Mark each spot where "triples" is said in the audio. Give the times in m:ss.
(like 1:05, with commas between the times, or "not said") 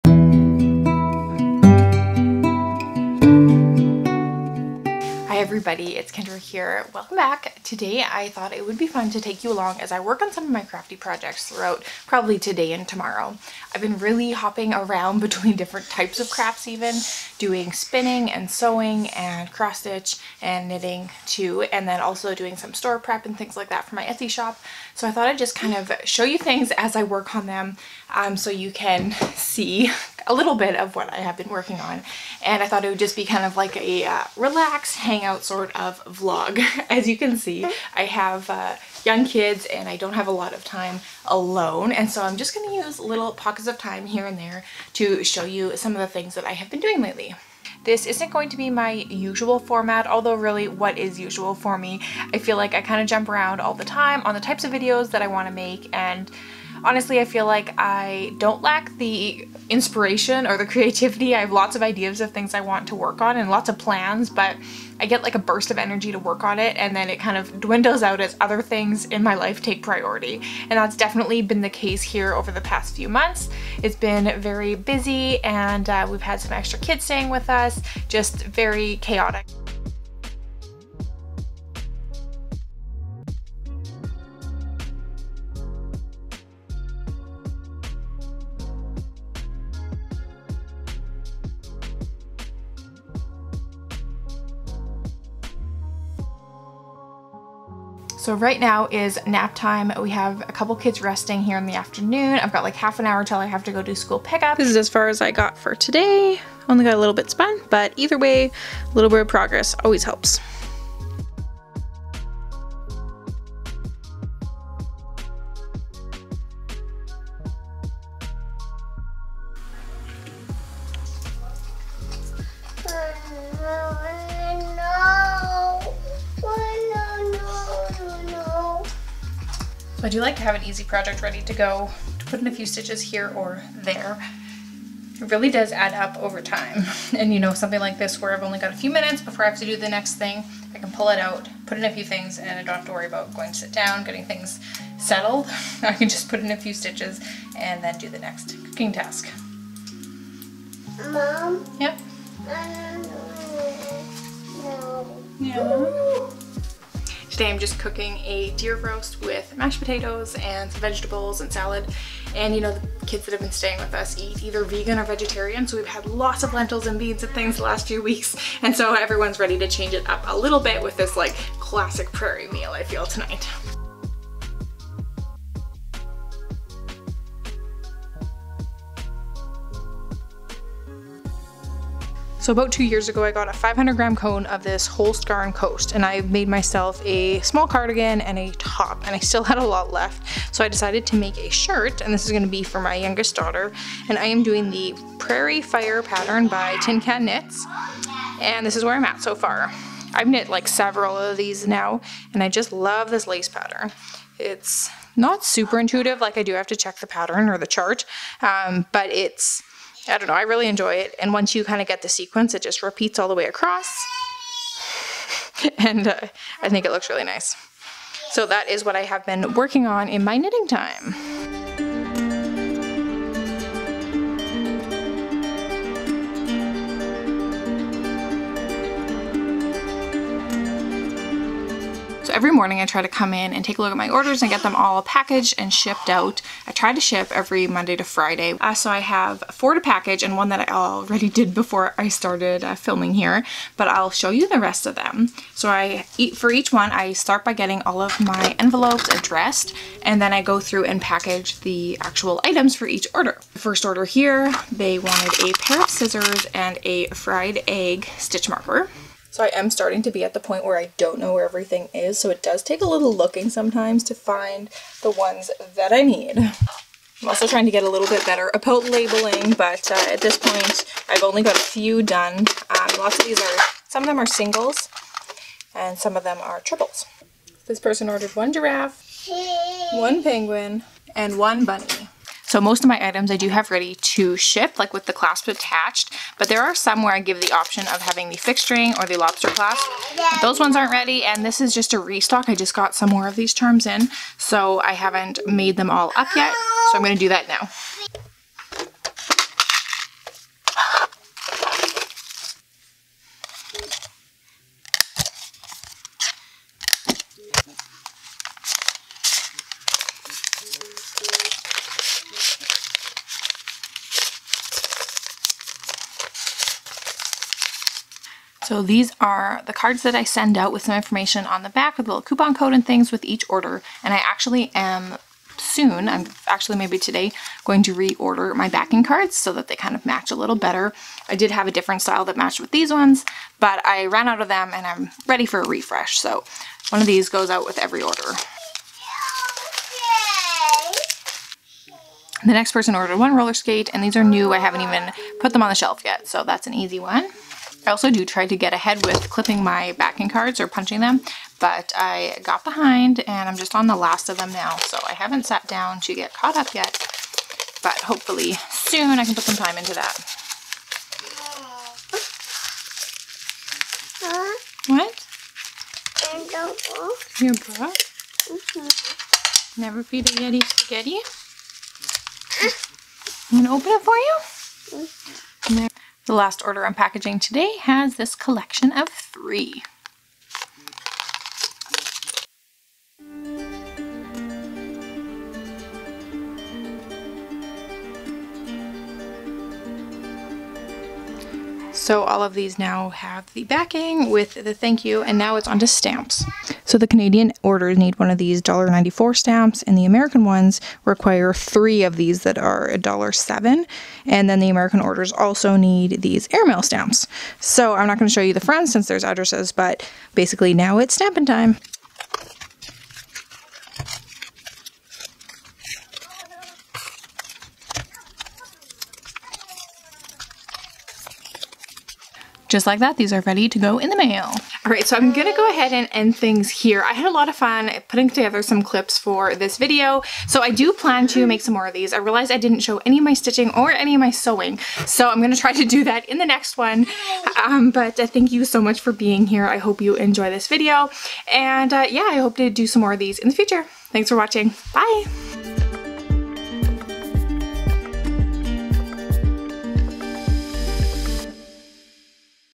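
4:36.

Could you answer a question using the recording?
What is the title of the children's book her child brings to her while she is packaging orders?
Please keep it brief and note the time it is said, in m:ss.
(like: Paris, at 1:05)
Never Feed a Yeti Spaghetti, at 6:09.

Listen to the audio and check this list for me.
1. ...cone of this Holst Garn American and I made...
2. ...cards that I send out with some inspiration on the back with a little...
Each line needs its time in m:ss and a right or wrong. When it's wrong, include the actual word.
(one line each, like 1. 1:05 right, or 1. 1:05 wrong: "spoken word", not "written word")
1. 3:04 wrong: "Coast", not "American"
2. 5:19 wrong: "information", not "inspiration".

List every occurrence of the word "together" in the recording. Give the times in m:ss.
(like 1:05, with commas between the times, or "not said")
7:08.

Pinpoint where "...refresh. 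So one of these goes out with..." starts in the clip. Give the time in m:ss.
5:35.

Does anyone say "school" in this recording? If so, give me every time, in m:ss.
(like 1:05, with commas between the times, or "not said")
1:43.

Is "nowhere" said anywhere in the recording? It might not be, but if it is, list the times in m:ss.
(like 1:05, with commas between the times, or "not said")
not said.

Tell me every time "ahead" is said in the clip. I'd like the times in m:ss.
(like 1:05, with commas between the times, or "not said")
5:48, 7:05.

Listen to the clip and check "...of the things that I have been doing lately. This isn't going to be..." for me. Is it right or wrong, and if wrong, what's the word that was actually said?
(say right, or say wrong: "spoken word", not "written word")
right.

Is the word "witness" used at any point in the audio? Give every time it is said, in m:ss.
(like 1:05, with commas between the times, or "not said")
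not said.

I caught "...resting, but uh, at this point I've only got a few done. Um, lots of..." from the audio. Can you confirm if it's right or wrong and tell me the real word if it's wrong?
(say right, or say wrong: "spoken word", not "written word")
wrong: "labeling", not "resting".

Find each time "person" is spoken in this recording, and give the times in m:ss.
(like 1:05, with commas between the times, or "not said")
4:37, 5:42.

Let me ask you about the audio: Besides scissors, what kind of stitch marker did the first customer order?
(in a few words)
Fried egg.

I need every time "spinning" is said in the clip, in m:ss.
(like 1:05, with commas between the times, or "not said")
0:17.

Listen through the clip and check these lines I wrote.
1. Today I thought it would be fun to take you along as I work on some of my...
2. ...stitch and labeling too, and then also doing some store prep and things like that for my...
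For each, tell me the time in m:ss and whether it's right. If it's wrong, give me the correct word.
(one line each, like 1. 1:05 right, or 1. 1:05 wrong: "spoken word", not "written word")
1. 0:07 right
2. 0:19 wrong: "knitting", not "labeling".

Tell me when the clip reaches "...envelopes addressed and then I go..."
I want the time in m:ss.
4:08.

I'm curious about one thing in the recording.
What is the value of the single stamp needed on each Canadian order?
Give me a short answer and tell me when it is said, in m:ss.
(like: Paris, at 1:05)
$1.94, at 6:38.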